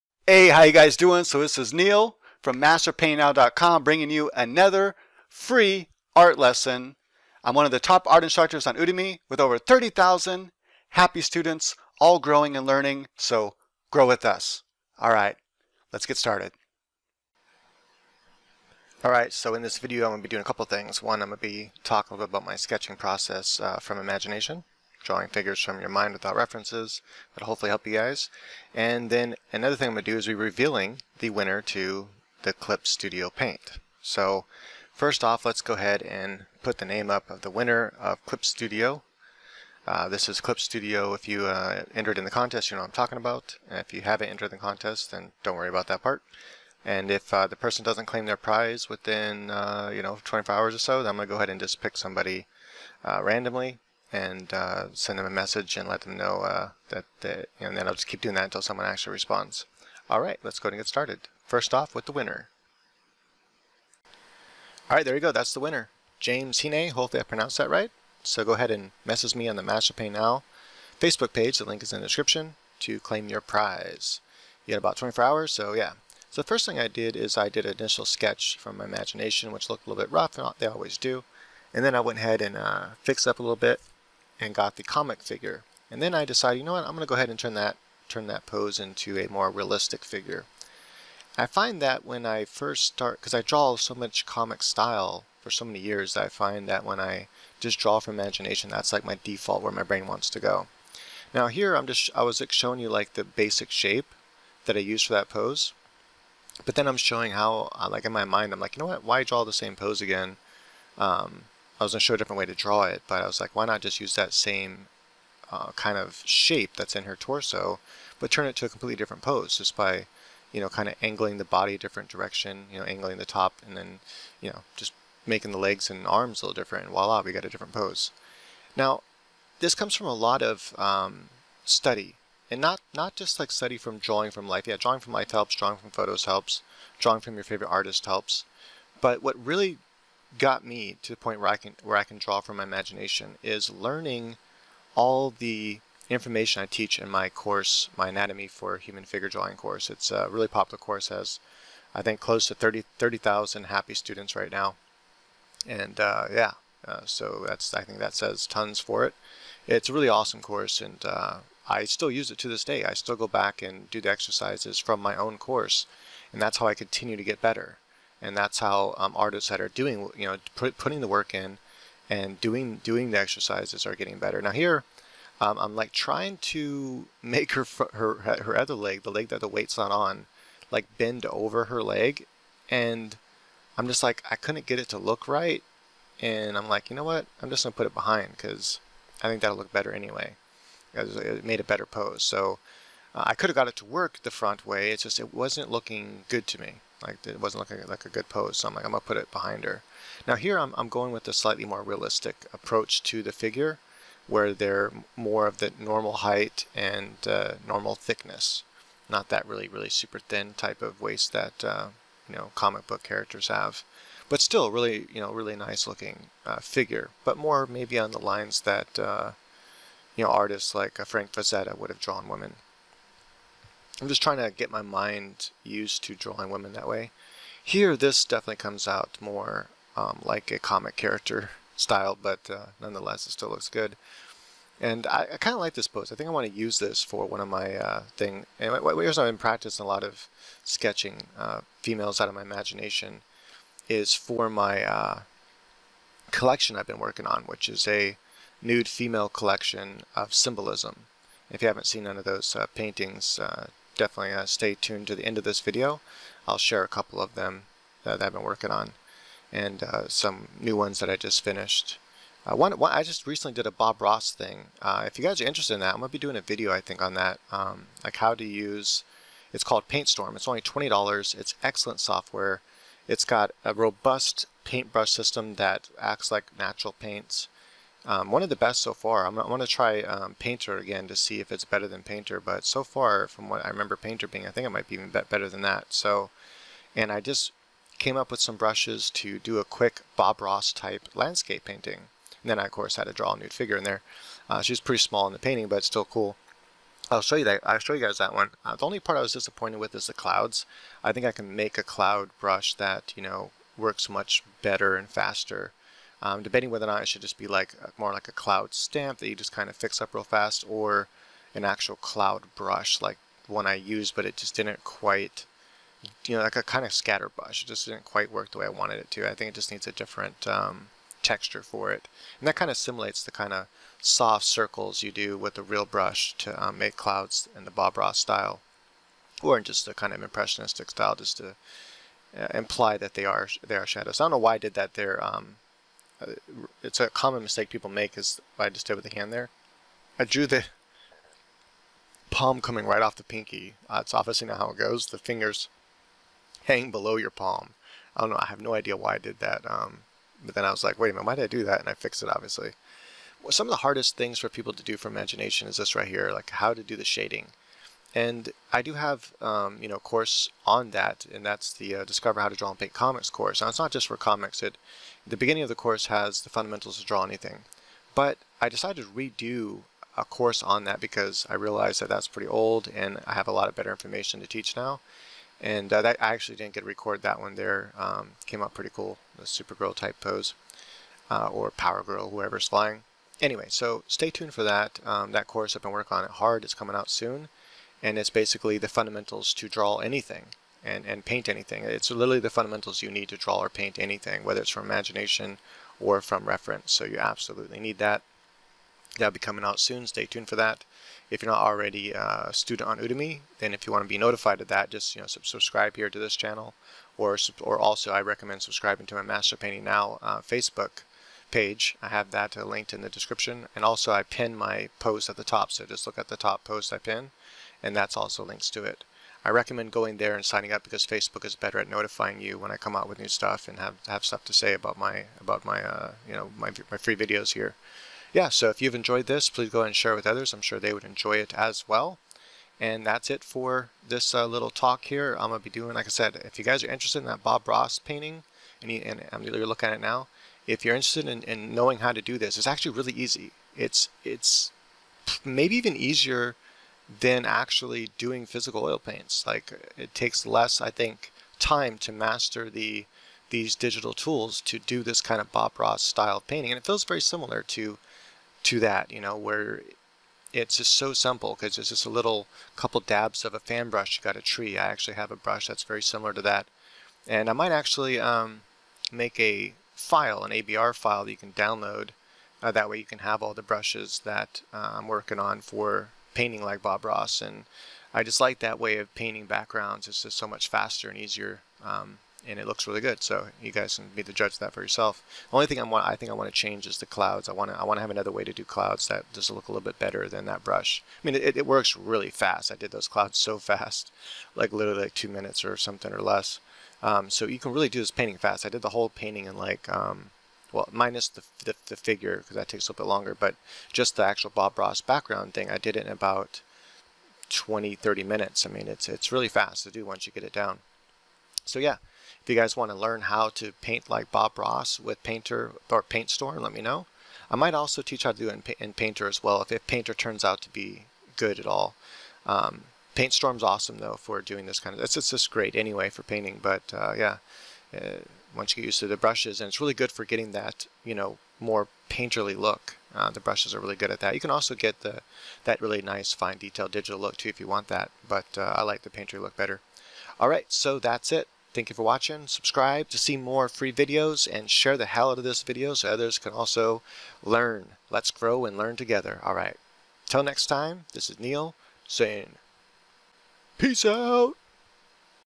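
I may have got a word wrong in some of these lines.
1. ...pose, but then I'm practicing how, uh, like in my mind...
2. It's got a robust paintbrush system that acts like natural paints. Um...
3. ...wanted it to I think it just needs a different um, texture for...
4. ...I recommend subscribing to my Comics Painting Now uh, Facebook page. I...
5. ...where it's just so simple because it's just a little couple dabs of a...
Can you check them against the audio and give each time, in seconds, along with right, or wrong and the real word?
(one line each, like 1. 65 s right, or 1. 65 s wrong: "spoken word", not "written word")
1. 105 s wrong: "showing", not "practicing"
2. 273 s right
3. 318 s right
4. 408 s wrong: "Master", not "Comics"
5. 459 s right.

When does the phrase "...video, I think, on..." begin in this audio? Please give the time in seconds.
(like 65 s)
266 s.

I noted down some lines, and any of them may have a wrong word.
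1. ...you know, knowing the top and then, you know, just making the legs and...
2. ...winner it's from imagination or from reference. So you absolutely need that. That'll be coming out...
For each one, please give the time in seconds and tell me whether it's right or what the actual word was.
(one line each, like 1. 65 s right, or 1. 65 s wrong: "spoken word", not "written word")
1. 122 s wrong: "angling", not "knowing"
2. 394 s wrong: "whether", not "winner".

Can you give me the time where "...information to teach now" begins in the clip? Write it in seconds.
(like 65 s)
373 s.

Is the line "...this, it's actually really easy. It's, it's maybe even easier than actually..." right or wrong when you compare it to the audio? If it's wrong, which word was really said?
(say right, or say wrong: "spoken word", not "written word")
right.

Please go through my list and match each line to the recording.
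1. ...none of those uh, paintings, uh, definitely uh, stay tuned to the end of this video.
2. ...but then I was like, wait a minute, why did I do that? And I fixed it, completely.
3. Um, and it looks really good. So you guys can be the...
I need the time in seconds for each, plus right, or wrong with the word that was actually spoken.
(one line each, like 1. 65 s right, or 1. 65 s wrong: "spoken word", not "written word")
1. 252 s right
2. 350 s wrong: "obviously", not "completely"
3. 481 s right.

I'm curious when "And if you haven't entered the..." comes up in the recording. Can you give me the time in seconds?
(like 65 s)
43 s.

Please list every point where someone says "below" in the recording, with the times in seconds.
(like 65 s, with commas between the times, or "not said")
346 s.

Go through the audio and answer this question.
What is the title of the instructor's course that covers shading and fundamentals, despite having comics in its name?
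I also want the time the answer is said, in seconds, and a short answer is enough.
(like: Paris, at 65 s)
Discover How to Draw and Paint Comics, at 362 s.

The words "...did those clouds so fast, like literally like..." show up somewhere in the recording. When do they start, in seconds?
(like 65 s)
492 s.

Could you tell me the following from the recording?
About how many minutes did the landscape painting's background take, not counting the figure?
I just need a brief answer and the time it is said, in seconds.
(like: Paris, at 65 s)
20-30 minutes, at 507 s.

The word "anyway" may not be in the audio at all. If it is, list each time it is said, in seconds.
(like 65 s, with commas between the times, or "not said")
189 s, 383 s, 525 s.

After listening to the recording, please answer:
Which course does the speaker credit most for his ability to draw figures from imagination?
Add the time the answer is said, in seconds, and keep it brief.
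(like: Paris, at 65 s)
Anatomy for Human Figure Drawing, at 148 s.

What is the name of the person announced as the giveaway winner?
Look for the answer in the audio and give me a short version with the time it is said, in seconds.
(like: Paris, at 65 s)
James Hine, at 66 s.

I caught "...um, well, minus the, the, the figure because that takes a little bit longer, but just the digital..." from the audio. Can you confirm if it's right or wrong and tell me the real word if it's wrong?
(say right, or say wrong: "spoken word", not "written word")
wrong: "actual", not "digital".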